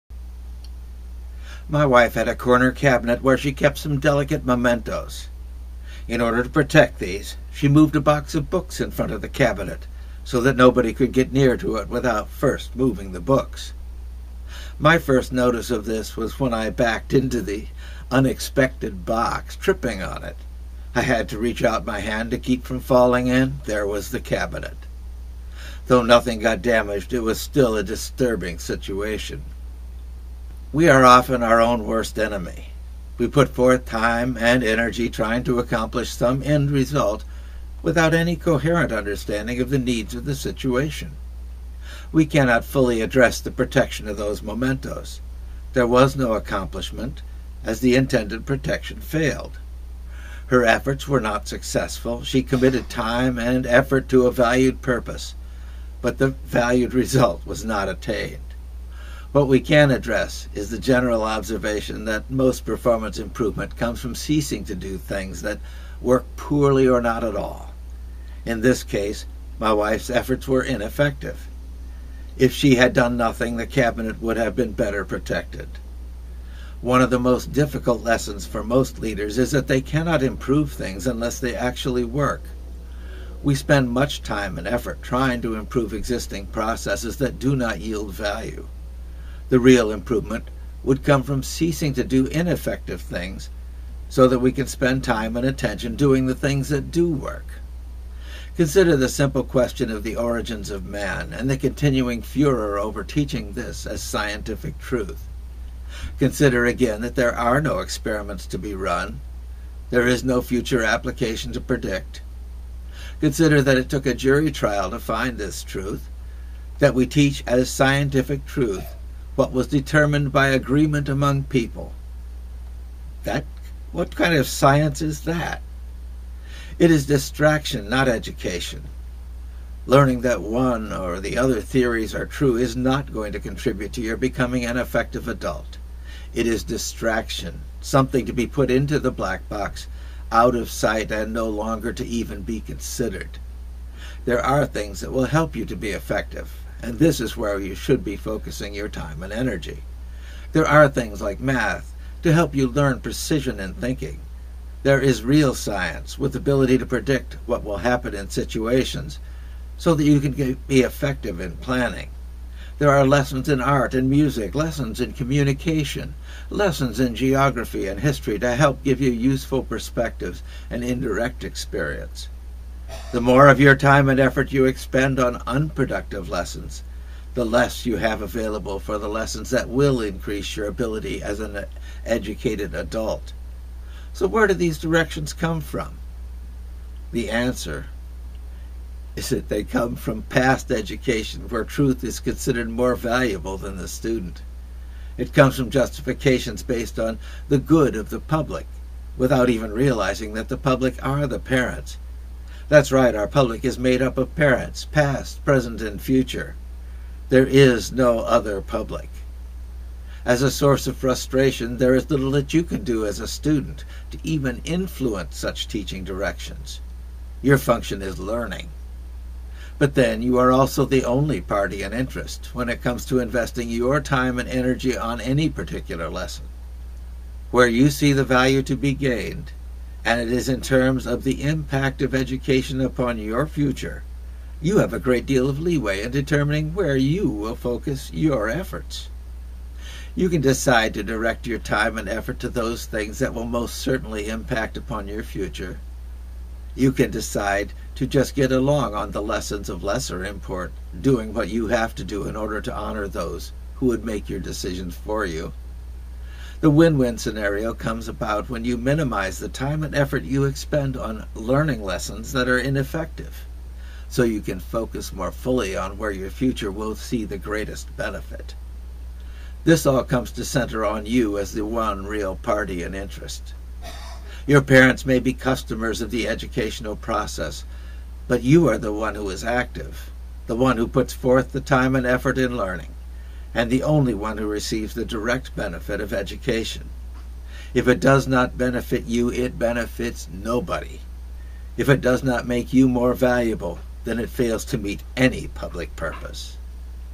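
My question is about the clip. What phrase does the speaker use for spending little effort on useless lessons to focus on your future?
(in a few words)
Win win scenario.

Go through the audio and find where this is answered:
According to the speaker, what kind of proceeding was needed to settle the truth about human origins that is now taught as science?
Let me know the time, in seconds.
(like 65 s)
114 s.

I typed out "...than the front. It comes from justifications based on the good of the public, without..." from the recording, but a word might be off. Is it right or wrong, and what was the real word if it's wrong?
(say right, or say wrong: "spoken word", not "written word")
wrong: "student", not "front".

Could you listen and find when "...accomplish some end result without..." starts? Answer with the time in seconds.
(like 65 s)
35 s.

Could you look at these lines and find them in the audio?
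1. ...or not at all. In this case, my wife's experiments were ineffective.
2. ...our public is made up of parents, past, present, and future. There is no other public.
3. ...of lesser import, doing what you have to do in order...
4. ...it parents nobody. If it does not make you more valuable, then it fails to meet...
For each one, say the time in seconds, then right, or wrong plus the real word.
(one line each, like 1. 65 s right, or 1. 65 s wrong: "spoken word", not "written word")
1. 66 s wrong: "efforts", not "experiments"
2. 203 s right
3. 249 s right
4. 289 s wrong: "benefits", not "parents".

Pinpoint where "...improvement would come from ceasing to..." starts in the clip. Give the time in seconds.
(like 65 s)
89 s.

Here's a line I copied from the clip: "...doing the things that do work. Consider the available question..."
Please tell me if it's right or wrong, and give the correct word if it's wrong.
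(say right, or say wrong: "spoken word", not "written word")
wrong: "simple", not "available".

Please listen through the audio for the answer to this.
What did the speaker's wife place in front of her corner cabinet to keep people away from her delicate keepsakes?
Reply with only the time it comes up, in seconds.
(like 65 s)
7 s.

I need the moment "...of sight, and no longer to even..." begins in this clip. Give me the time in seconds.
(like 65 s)
140 s.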